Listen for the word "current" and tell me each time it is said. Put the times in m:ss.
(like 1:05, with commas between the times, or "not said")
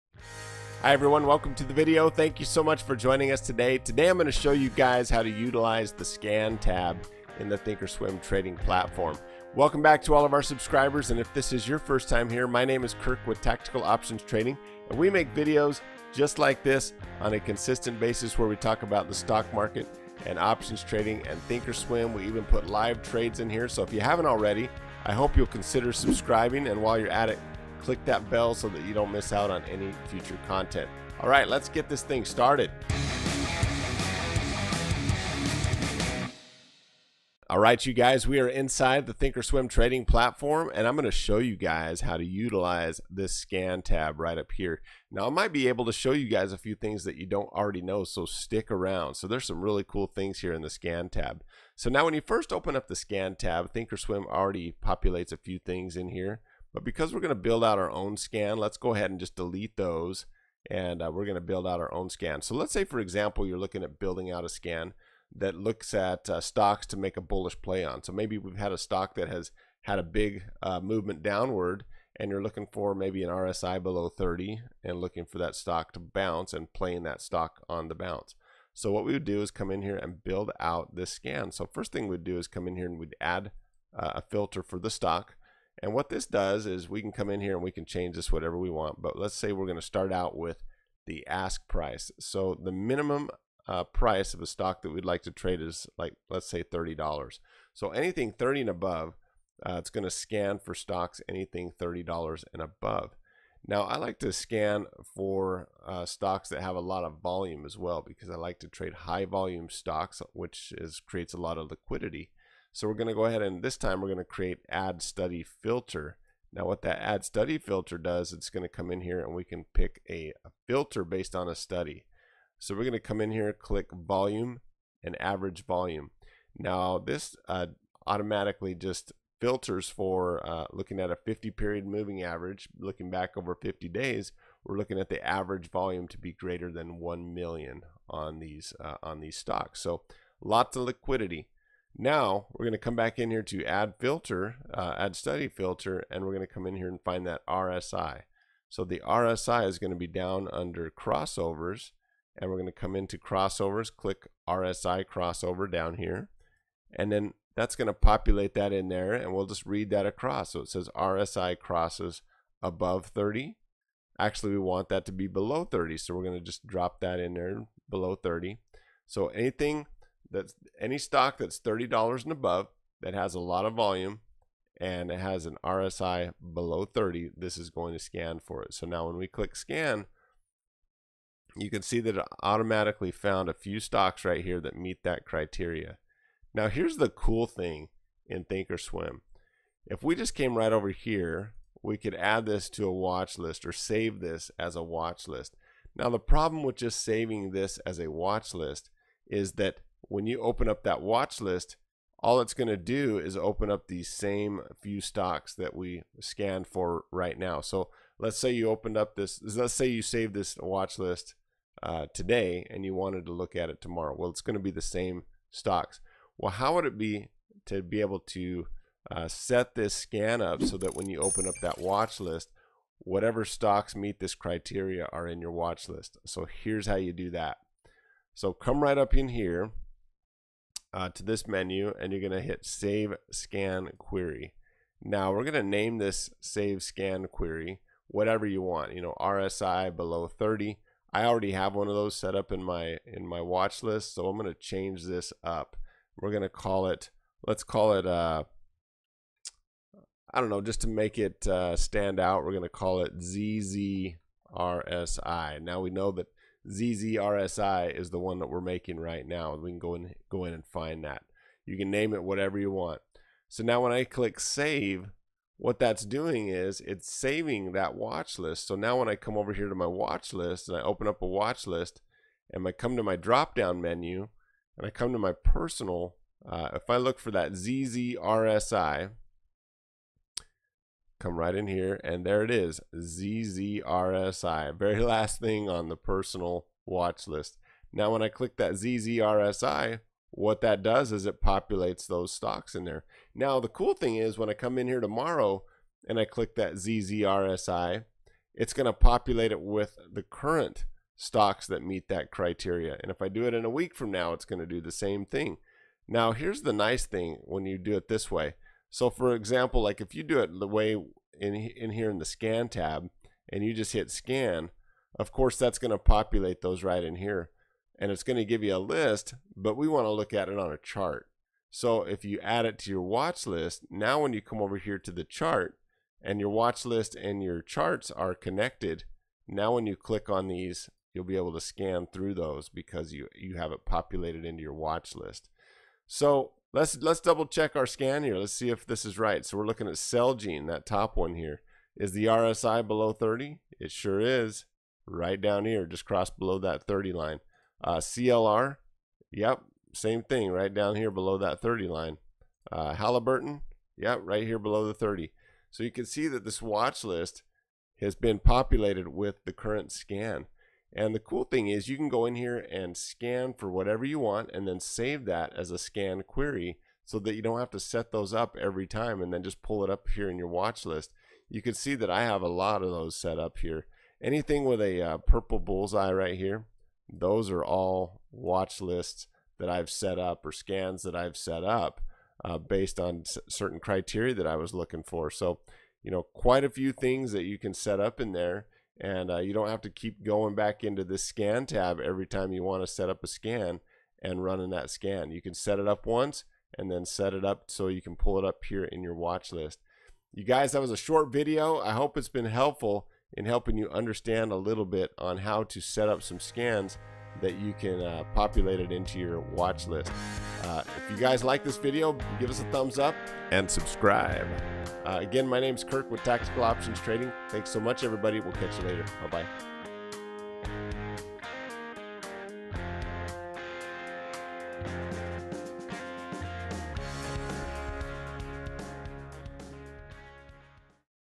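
5:00, 5:59.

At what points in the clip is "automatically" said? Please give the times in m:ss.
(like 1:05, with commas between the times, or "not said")
2:08, 3:02.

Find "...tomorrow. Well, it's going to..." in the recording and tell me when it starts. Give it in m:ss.
3:33.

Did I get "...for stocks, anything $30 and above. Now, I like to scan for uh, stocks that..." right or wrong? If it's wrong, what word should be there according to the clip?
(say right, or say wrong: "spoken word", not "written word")
right.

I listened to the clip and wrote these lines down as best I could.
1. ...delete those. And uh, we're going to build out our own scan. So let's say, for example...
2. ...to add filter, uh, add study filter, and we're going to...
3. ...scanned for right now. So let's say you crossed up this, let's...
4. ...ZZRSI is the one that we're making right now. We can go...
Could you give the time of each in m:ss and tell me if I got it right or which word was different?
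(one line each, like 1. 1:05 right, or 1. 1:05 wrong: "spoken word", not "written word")
1. 0:59 right
2. 2:23 right
3. 3:26 wrong: "opened", not "crossed"
4. 4:16 right.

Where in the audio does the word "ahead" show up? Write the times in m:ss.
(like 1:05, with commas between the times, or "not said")
0:58, 1:53.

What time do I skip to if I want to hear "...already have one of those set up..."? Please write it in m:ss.
4:01.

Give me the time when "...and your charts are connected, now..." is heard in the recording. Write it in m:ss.
5:27.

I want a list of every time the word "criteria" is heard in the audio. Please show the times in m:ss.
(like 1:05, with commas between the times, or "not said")
3:05, 3:44, 5:02, 6:23.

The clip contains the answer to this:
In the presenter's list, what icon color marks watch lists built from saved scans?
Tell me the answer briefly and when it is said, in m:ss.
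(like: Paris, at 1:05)
purple, at 6:15.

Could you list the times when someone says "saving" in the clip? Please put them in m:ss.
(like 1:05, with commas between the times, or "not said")
3:17, 4:27.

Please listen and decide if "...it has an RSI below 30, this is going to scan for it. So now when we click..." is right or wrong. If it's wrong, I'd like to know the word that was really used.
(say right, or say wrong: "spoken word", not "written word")
right.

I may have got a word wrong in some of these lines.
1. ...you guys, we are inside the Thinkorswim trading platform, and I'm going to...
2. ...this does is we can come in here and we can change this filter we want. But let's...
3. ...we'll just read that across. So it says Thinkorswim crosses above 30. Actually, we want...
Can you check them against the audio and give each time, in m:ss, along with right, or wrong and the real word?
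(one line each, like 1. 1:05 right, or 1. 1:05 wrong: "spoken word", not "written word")
1. 0:37 right
2. 1:26 wrong: "whatever", not "filter"
3. 2:39 wrong: "RSI", not "Thinkorswim".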